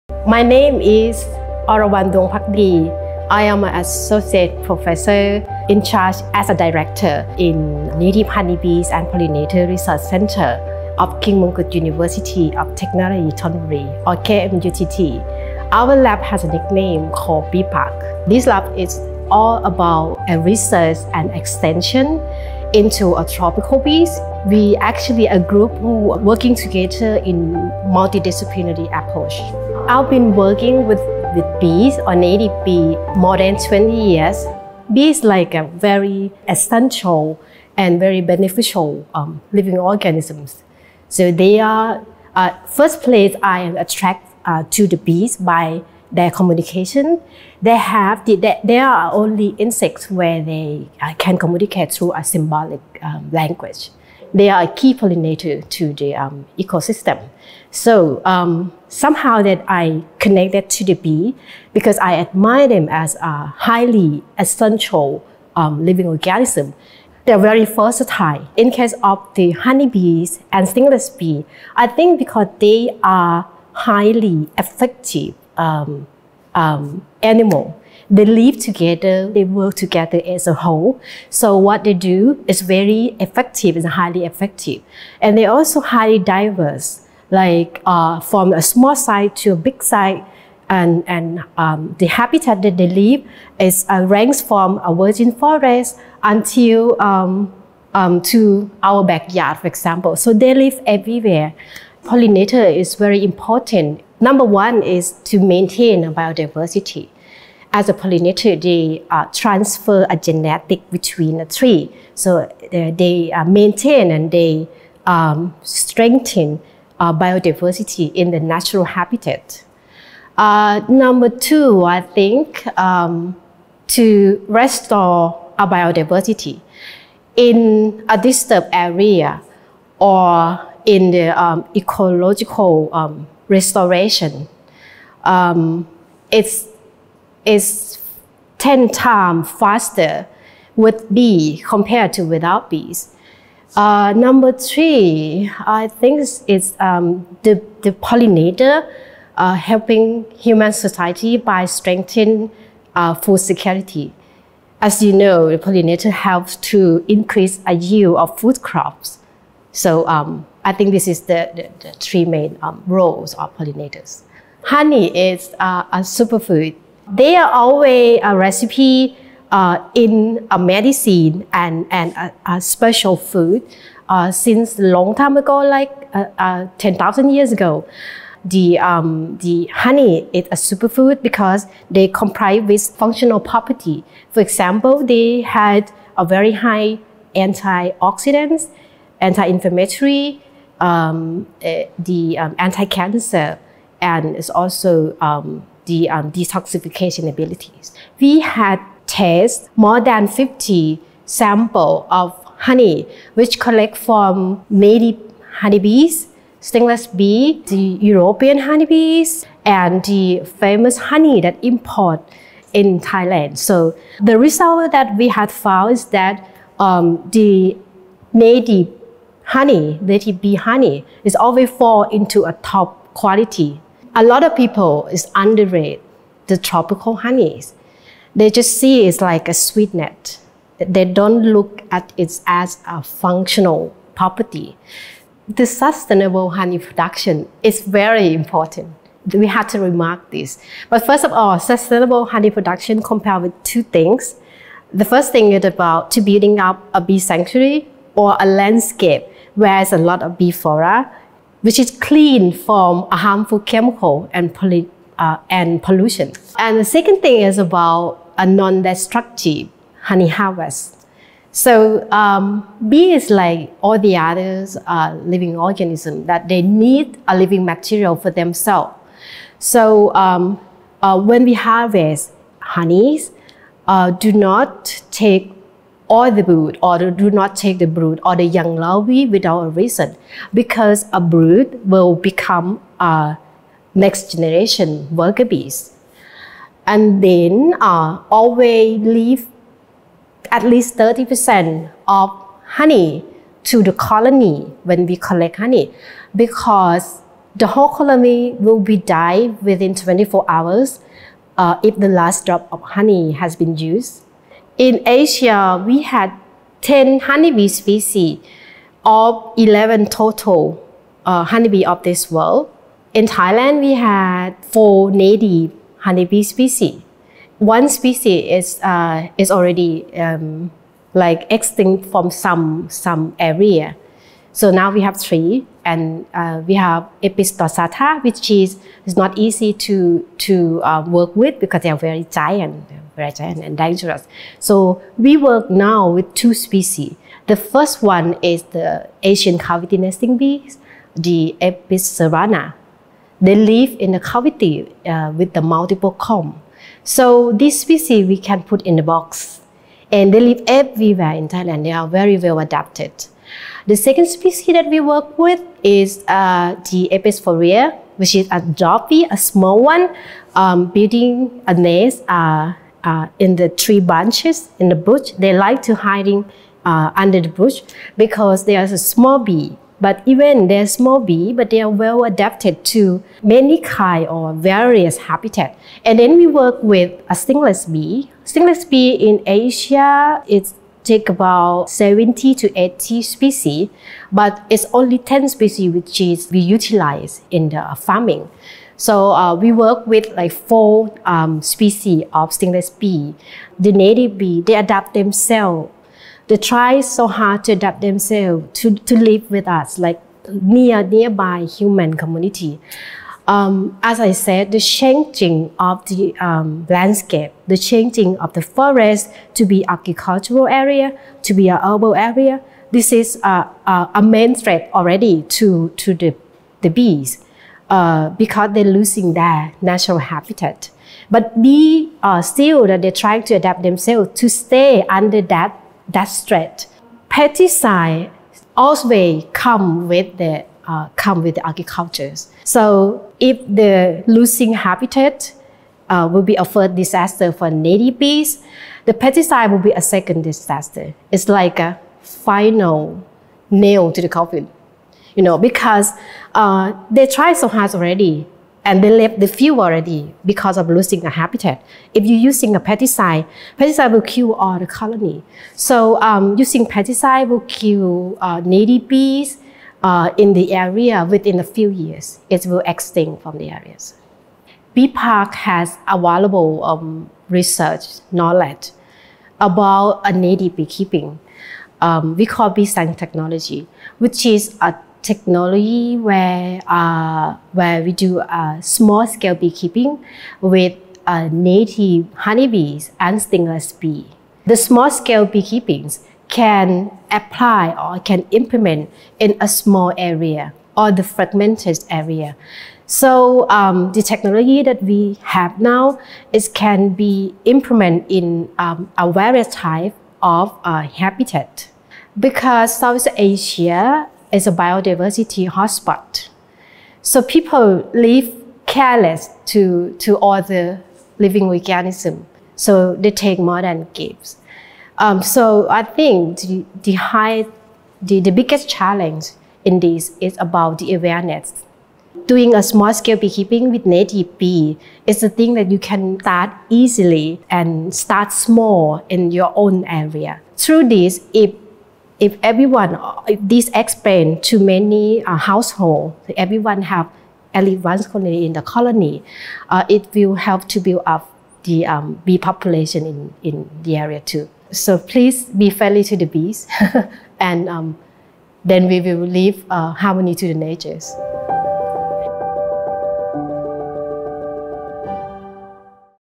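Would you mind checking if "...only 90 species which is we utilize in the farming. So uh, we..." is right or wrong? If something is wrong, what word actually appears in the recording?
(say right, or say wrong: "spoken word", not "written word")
wrong: "10", not "90".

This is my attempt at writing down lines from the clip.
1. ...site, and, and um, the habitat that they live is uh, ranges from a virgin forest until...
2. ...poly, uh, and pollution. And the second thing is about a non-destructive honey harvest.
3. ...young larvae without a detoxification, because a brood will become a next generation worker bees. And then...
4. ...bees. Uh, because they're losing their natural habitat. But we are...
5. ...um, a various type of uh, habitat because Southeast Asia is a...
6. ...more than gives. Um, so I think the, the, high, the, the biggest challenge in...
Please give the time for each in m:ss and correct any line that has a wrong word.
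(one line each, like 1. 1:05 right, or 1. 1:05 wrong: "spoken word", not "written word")
1. 1:29 right
2. 4:14 right
3. 4:38 wrong: "reason", not "detoxification"
4. 6:56 right
5. 8:18 right
6. 8:33 right.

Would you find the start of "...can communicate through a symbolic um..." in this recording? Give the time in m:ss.
0:51.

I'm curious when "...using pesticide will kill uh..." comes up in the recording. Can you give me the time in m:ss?
7:36.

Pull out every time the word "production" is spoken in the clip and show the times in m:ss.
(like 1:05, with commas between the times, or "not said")
3:56, 4:02.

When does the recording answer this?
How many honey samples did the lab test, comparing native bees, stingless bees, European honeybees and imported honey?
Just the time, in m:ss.
3:19.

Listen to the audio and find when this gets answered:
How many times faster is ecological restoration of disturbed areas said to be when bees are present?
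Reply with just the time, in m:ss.
2:18.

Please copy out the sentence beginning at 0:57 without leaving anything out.
So um, somehow that I connected to the bee because I admire them as a highly essential um, living organism.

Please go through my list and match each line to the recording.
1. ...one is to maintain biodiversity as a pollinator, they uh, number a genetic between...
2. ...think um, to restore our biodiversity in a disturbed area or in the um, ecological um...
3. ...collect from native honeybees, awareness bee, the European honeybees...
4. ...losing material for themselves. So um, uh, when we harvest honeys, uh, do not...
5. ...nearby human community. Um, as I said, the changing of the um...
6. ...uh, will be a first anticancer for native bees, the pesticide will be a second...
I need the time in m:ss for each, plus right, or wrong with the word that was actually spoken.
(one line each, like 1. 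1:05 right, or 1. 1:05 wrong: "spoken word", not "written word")
1. 1:44 wrong: "transfer", not "number"
2. 2:02 right
3. 3:23 wrong: "stingless", not "awareness"
4. 4:27 wrong: "living", not "losing"
5. 6:41 right
6. 7:16 wrong: "disaster", not "anticancer".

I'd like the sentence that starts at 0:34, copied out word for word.
Bees like a very essential and very beneficial um, living organisms.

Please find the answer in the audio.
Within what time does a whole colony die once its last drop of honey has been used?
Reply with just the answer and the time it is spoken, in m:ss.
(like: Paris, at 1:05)
24 hours, at 4:59.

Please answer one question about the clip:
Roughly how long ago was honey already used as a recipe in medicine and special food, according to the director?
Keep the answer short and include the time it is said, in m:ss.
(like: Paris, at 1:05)
10,000 years, at 2:56.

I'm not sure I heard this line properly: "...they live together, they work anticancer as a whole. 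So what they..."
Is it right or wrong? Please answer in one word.
wrong.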